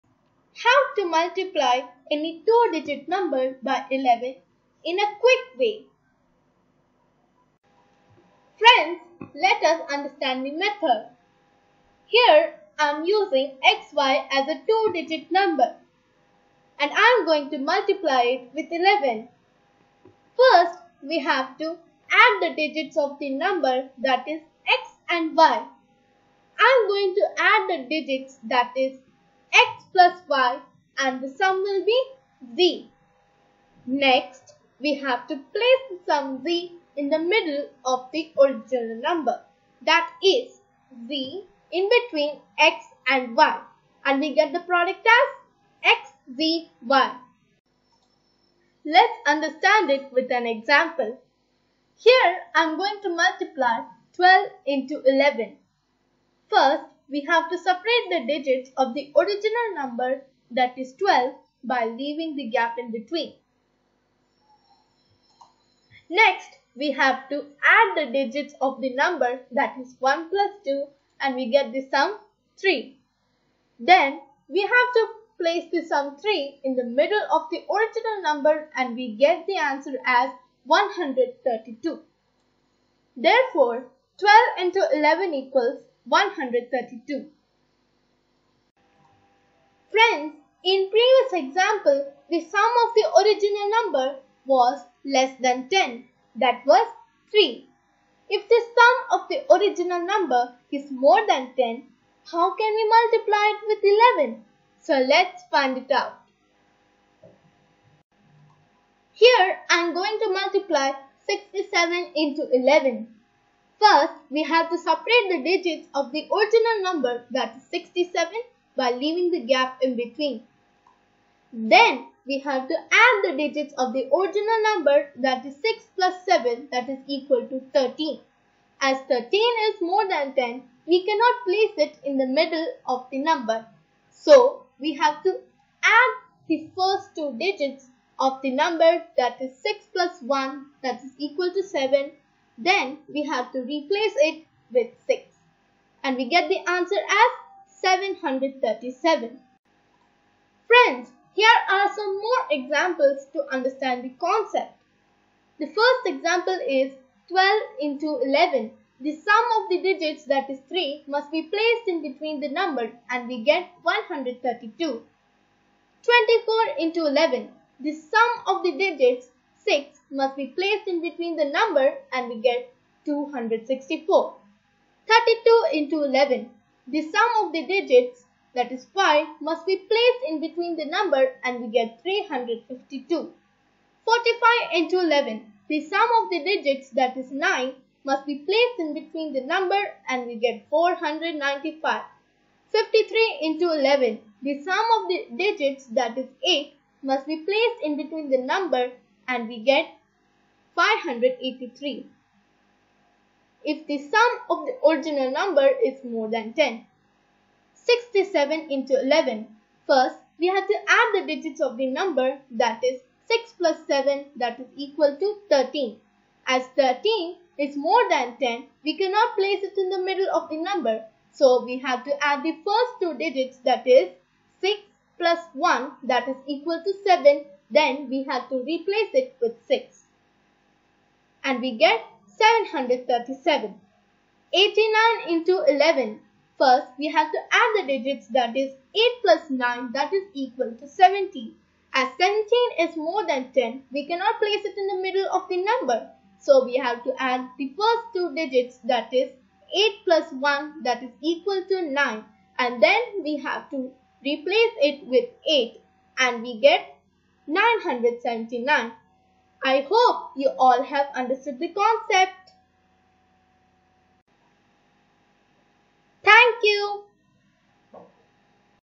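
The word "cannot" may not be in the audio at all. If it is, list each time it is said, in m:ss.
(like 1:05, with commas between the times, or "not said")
2:11, 3:38, 4:04.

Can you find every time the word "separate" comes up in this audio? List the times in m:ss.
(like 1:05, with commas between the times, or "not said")
0:57, 1:54.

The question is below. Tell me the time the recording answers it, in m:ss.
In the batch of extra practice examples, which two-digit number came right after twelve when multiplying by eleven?
2:46.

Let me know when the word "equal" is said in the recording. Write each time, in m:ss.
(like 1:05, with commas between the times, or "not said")
1:25, 2:07, 2:21, 3:34, 3:46, 4:00, 4:11.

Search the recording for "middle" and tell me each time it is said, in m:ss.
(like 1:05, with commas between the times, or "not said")
0:37, 1:16, 2:12, 3:40, 4:05.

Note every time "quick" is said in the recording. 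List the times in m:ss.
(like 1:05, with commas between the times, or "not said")
0:05.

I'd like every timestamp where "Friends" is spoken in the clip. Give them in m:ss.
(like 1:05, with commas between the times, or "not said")
0:08, 1:29, 2:30.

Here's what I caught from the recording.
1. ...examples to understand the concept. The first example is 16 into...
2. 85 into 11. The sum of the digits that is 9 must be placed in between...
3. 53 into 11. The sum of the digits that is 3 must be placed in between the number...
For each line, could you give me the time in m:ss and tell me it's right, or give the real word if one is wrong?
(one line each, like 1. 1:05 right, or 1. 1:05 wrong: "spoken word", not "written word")
1. 2:32 wrong: "12", not "16"
2. 3:04 wrong: "45", not "85"
3. 3:12 wrong: "8", not "3".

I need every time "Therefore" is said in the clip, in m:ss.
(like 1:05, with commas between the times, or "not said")
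1:23.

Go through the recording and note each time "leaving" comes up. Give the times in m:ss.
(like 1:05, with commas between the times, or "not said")
1:01, 1:58.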